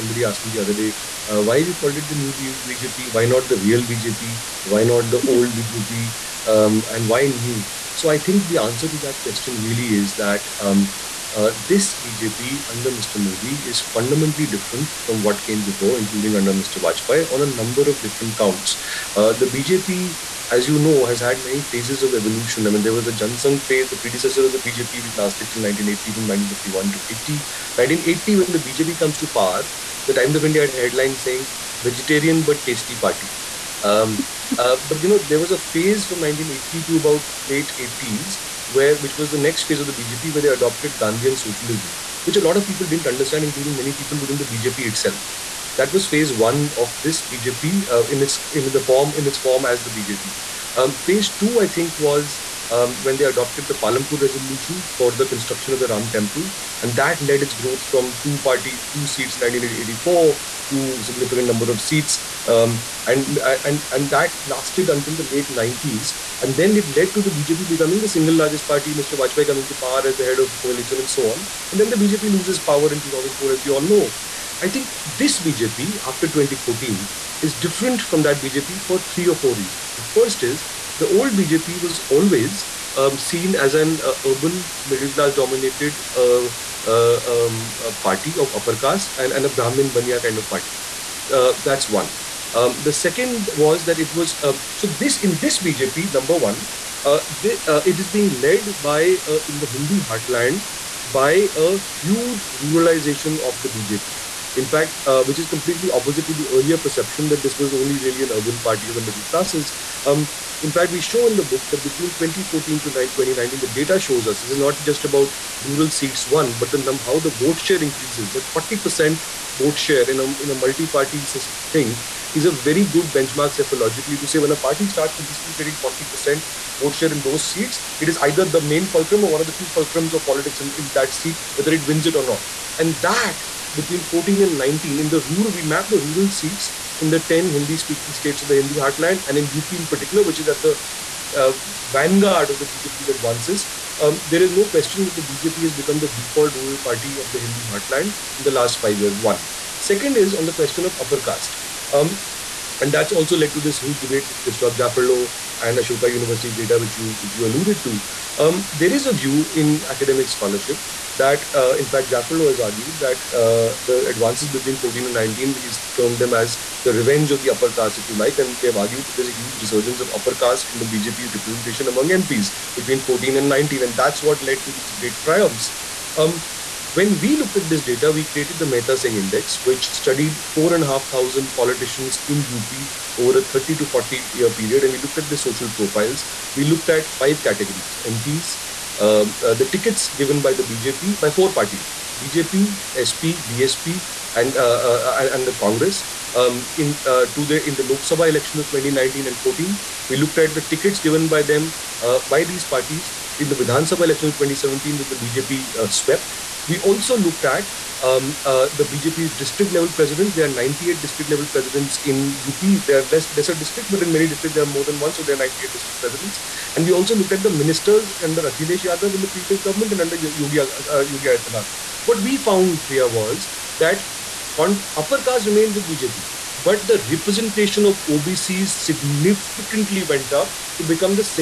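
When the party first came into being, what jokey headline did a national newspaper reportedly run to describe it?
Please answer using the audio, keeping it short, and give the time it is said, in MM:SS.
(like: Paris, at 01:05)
Vegetarian but Tasty Party, at 00:31.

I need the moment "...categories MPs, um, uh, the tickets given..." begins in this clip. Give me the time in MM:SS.
03:07.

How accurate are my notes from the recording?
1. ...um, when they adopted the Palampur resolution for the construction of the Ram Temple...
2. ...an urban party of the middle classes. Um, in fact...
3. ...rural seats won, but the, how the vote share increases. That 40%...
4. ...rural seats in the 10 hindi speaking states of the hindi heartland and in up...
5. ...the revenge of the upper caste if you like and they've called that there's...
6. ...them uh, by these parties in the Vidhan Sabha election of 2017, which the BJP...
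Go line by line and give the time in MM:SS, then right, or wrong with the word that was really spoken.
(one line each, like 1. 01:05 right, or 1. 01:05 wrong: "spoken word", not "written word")
1. 00:52 right
2. 01:48 right
3. 01:55 right
4. 02:15 right
5. 02:46 wrong: "argued", not "called"
6. 03:21 right.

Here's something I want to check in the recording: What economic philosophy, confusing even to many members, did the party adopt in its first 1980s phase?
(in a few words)
Gandhian socialism.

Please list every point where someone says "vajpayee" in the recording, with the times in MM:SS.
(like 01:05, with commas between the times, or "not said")
00:16, 01:09.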